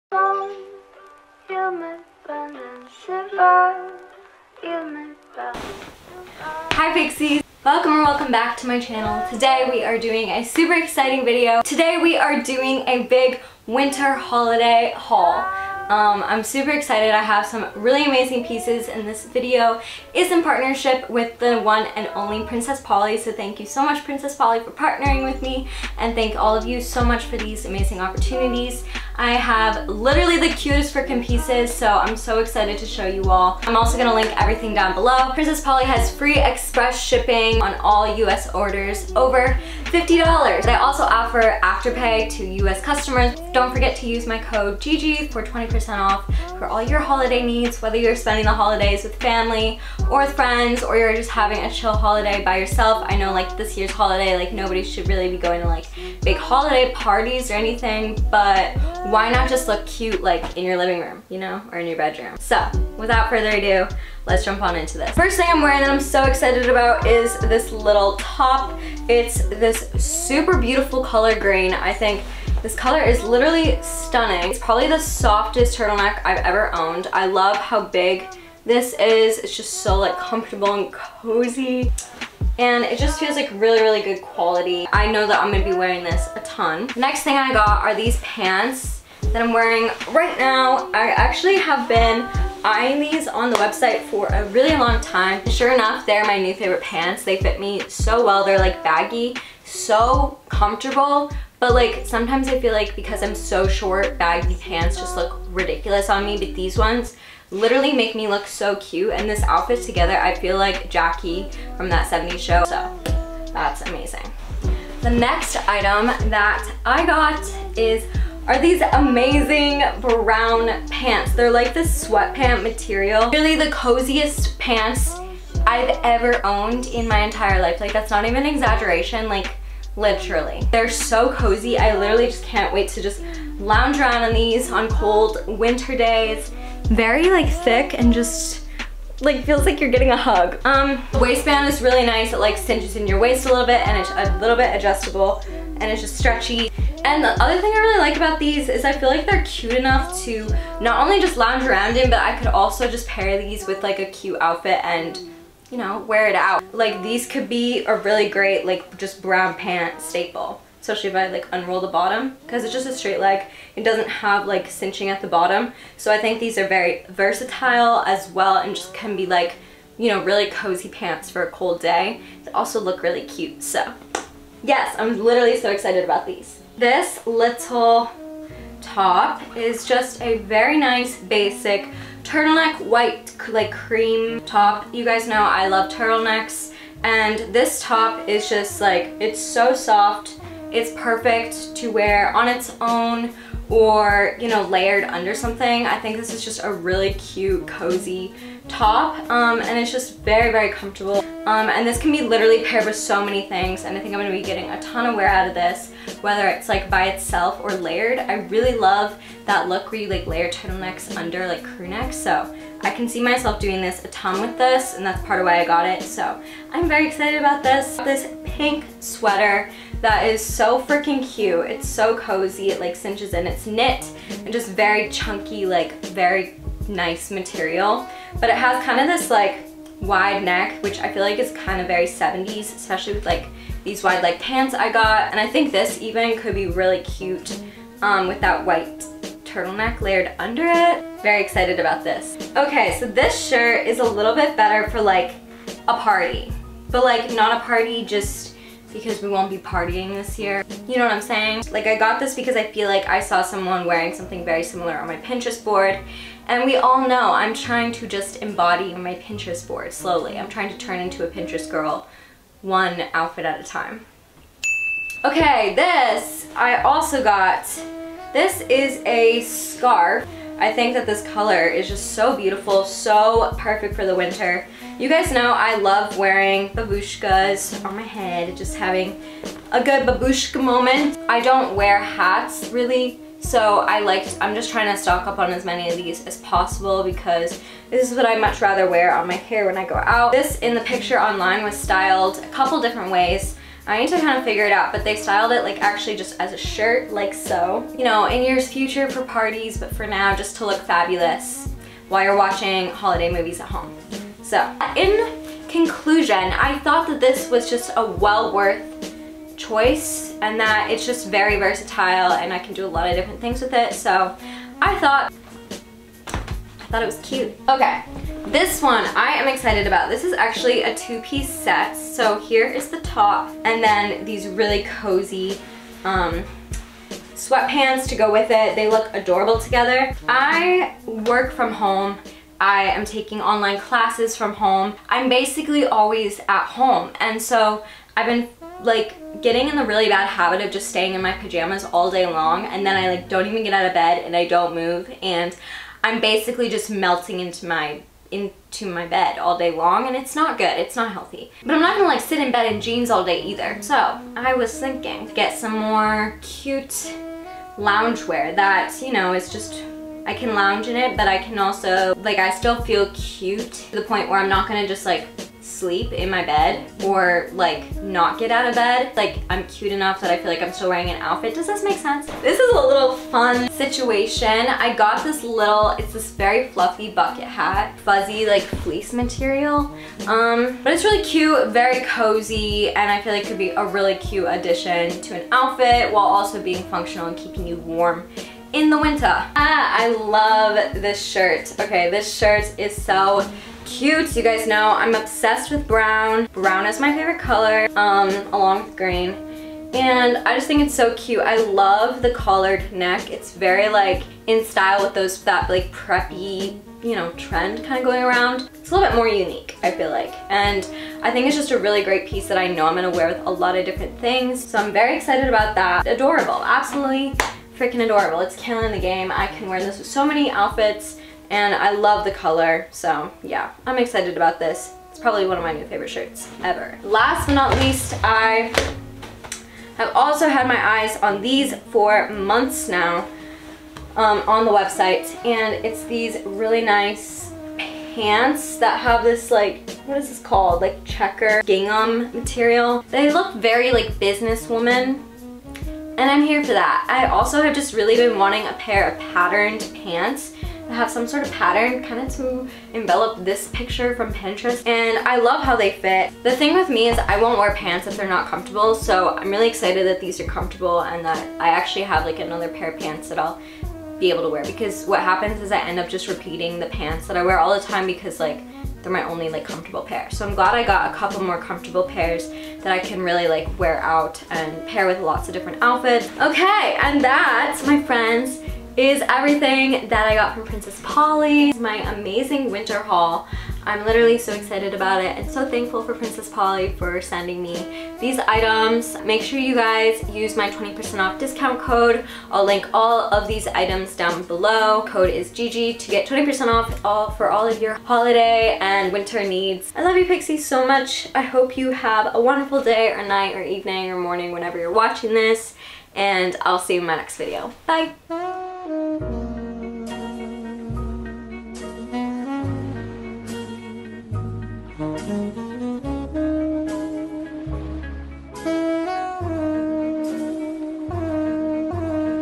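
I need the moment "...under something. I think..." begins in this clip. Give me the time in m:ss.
3:15.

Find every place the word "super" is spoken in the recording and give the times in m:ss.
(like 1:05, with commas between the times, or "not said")
0:10, 0:16, 1:09.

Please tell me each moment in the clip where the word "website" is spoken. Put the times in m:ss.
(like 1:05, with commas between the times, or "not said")
1:33, 7:14.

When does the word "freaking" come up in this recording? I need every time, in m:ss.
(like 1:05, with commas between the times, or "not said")
0:30, 3:40, 6:57.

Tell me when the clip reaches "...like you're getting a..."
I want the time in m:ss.
2:19.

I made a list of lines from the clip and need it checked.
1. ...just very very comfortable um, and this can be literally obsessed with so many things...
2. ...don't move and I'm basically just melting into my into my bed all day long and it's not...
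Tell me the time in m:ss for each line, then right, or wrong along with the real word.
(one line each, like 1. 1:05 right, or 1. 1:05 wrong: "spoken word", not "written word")
1. 3:19 wrong: "paired", not "obsessed"
2. 5:44 right.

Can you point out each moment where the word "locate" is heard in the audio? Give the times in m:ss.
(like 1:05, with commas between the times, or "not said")
not said.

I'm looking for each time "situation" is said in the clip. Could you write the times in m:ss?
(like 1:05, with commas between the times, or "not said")
6:13.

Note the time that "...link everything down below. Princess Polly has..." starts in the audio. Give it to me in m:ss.
0:34.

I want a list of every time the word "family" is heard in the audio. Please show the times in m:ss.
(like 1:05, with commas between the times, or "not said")
0:49.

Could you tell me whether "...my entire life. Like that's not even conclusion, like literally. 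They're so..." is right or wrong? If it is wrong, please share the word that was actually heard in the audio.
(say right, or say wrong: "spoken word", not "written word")
wrong: "exaggeration", not "conclusion".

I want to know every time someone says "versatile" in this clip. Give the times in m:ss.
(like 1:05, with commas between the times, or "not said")
2:47, 5:11.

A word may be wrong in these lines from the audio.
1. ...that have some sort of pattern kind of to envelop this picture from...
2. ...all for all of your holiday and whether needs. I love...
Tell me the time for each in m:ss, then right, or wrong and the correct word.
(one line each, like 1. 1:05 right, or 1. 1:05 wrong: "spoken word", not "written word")
1. 7:30 right
2. 8:17 wrong: "winter", not "whether".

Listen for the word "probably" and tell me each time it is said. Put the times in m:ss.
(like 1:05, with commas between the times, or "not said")
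1:14, 7:05.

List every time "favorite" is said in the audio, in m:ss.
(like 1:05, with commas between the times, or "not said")
1:36, 6:37, 7:05.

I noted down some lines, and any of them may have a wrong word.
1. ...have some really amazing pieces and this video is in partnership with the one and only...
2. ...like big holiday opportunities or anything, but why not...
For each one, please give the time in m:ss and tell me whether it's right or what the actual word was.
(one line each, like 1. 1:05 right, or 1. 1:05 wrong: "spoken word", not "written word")
1. 0:17 right
2. 0:55 wrong: "parties", not "opportunities".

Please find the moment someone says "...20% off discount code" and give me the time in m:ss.
8:10.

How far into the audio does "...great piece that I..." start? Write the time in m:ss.
6:52.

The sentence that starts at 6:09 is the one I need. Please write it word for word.
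Like I'm cute enough that I feel like I'm still wearing an outfit.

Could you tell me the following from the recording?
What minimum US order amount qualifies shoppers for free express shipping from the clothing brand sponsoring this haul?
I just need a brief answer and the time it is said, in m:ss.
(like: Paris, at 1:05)
$50, at 0:39.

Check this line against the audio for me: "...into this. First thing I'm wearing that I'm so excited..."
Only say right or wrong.
right.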